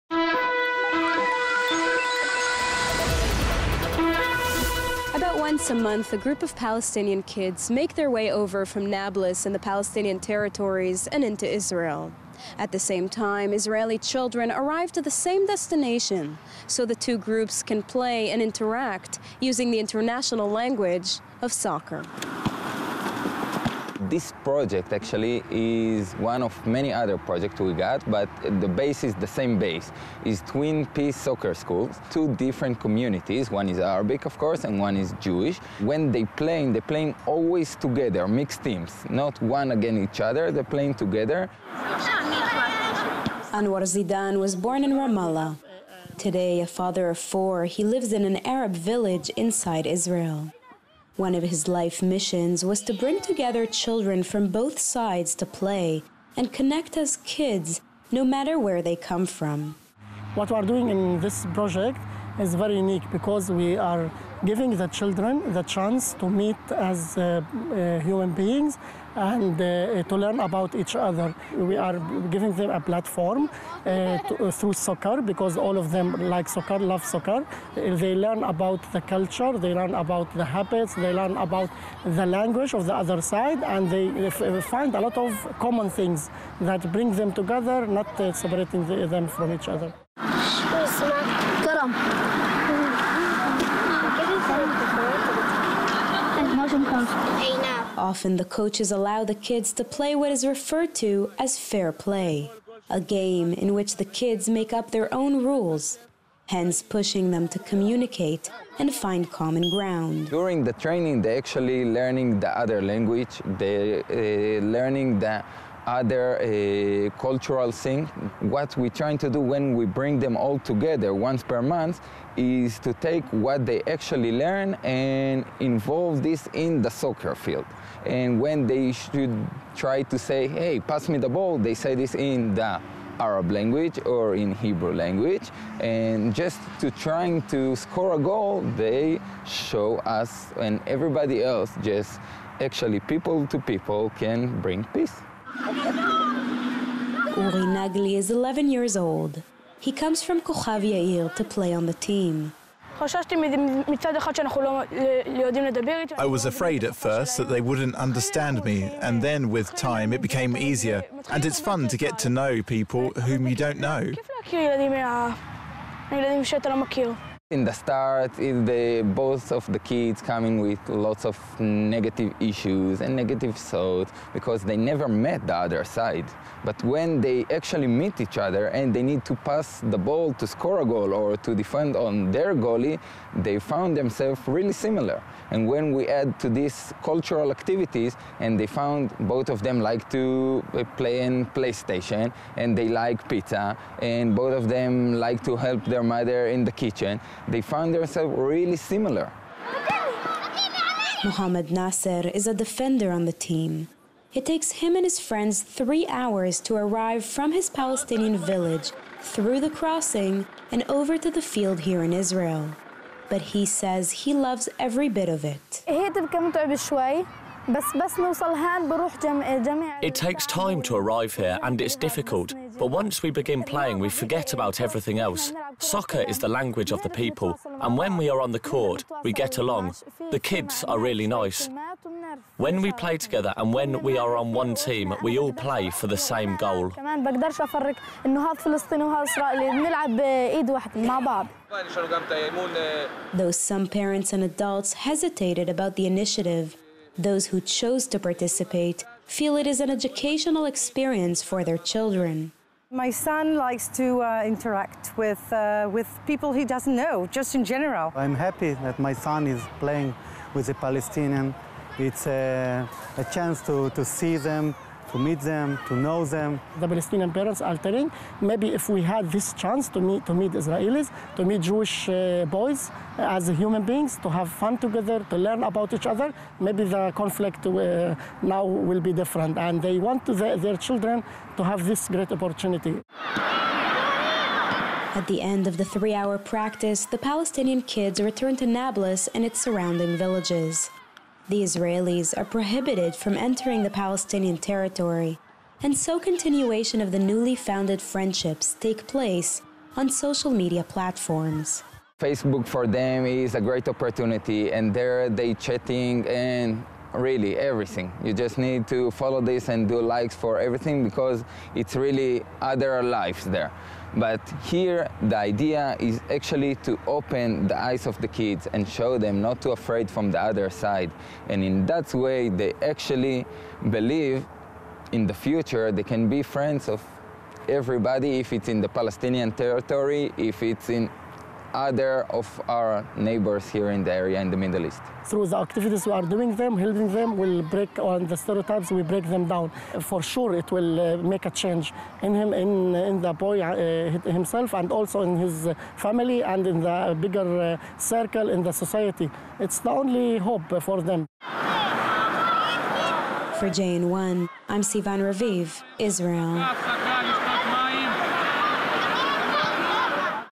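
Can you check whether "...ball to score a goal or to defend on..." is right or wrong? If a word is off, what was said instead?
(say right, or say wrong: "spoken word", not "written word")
right.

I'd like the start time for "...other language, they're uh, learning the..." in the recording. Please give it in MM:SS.
01:52.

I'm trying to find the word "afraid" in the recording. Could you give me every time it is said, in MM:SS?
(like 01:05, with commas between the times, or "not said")
02:36, 05:19.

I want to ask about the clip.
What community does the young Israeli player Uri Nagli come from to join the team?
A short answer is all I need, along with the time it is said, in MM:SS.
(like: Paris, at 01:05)
Kochav Yair, at 02:30.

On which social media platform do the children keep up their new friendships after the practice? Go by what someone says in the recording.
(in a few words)
Facebook.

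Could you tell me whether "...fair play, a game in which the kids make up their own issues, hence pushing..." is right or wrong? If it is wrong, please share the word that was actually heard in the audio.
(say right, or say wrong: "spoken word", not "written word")
wrong: "rules", not "issues".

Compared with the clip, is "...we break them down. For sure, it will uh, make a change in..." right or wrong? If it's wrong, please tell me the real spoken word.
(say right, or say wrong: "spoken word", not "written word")
right.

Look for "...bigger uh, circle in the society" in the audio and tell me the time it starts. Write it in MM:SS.
05:47.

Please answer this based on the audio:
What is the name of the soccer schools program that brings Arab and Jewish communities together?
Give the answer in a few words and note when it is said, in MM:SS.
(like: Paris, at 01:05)
Twin Peace Soccer Schools, at 00:30.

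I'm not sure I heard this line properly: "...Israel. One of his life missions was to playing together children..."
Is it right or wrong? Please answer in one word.
wrong.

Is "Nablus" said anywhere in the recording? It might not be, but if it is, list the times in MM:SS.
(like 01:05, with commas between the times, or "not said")
00:08, 04:48.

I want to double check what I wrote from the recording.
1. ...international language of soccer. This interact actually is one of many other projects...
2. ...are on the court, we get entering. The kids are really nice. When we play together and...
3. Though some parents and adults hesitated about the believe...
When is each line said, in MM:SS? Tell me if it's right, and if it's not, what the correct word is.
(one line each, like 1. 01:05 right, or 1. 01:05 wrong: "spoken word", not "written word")
1. 00:19 wrong: "project", not "interact"
2. 03:48 wrong: "along", not "entering"
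3. 04:03 wrong: "initiative", not "believe".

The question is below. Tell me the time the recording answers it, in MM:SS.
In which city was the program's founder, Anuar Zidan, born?
00:44.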